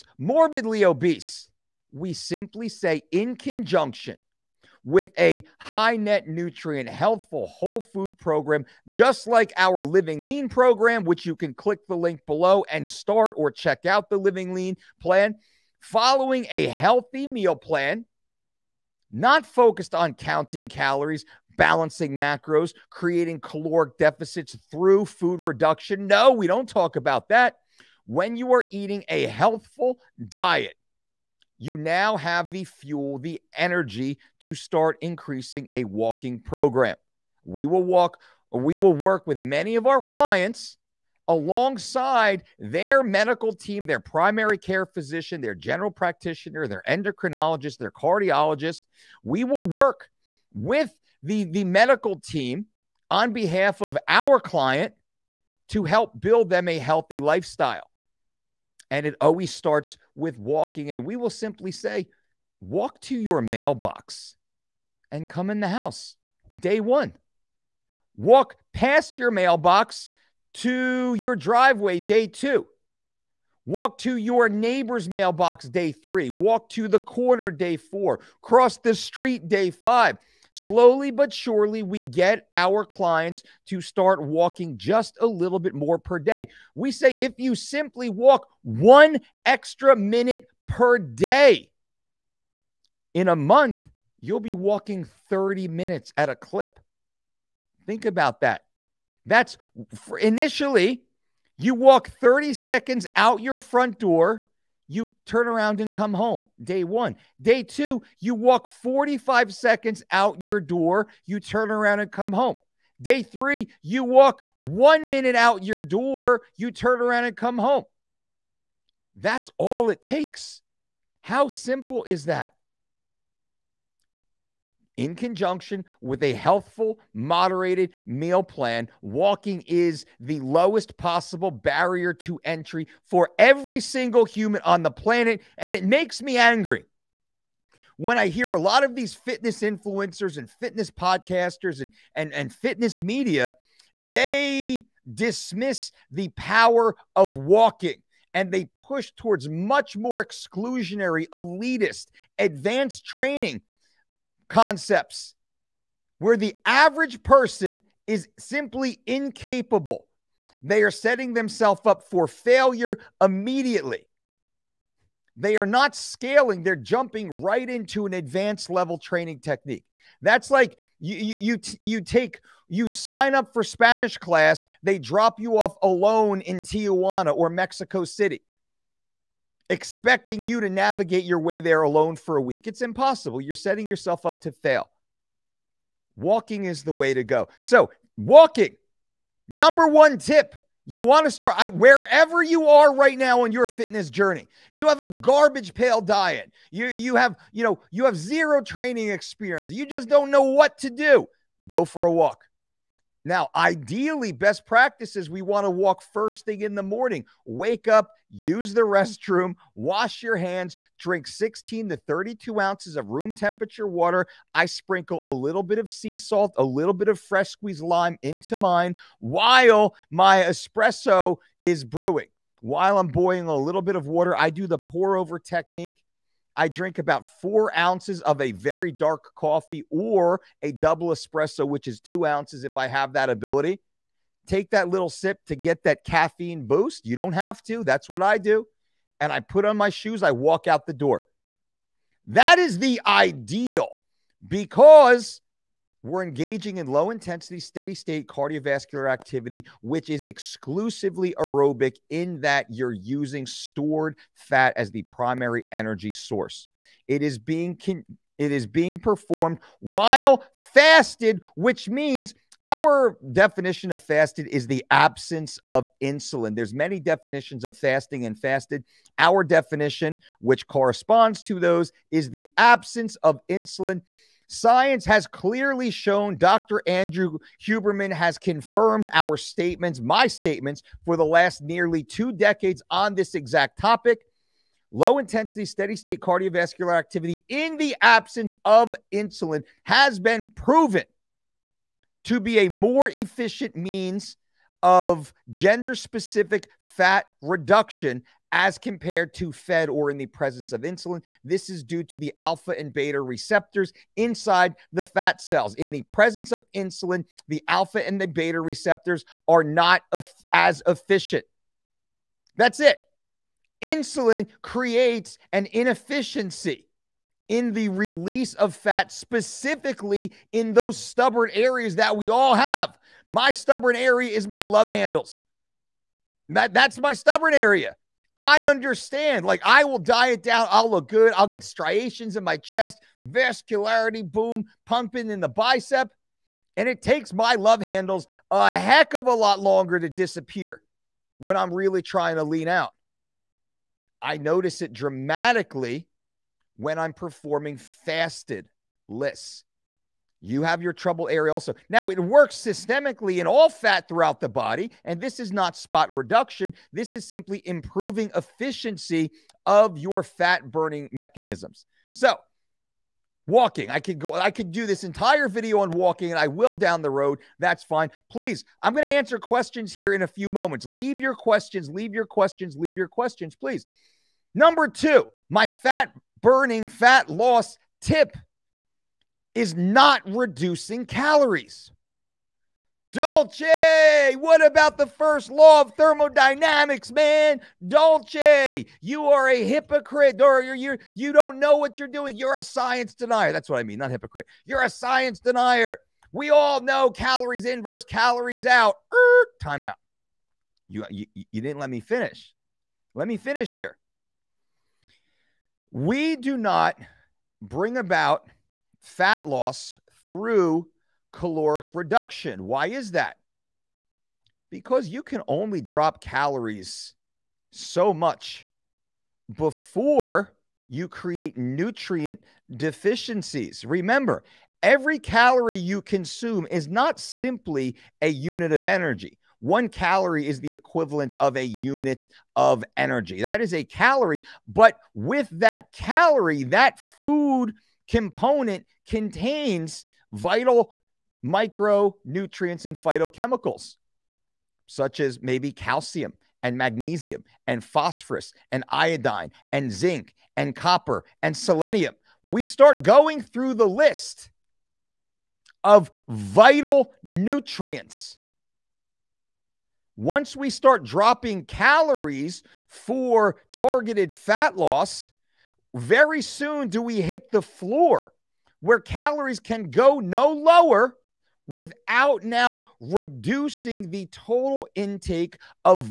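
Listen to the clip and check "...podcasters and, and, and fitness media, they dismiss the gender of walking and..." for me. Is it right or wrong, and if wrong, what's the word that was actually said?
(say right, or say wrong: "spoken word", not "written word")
wrong: "power", not "gender".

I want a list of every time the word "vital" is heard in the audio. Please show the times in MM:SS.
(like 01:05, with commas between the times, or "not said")
07:20, 07:36.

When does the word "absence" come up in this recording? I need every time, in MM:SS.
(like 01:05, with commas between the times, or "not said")
04:24, 04:32, 04:48.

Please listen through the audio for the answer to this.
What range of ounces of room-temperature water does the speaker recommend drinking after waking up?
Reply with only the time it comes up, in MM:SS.
03:31.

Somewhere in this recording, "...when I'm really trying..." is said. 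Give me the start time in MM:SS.
05:41.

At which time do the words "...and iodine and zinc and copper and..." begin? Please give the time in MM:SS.
07:28.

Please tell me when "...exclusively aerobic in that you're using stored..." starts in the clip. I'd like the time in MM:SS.
04:10.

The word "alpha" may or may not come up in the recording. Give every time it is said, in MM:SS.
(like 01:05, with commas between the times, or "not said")
05:02, 05:07.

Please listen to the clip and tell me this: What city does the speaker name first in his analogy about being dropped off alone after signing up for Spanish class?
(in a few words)
Tijuana.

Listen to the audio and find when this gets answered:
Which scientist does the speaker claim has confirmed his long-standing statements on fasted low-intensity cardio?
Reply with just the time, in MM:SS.
04:36.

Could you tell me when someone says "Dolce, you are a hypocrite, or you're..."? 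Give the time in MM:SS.
06:27.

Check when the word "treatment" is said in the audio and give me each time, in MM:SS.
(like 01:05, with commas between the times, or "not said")
not said.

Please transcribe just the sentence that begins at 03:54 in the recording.
Take that little sip to get that caffeine boost.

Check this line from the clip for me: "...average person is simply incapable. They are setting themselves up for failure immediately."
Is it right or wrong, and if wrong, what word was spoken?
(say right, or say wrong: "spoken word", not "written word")
right.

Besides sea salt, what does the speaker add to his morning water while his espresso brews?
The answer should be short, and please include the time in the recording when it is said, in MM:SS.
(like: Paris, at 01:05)
fresh squeezed lime, at 03:37.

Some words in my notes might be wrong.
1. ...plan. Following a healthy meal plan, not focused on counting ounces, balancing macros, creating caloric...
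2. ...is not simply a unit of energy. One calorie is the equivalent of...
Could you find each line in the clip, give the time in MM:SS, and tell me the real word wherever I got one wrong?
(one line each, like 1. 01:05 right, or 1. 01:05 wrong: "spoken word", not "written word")
1. 00:14 wrong: "calories", not "ounces"
2. 07:06 right.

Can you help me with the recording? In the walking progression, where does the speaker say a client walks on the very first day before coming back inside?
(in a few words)
to your mailbox.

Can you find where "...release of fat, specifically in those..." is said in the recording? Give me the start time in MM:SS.
05:17.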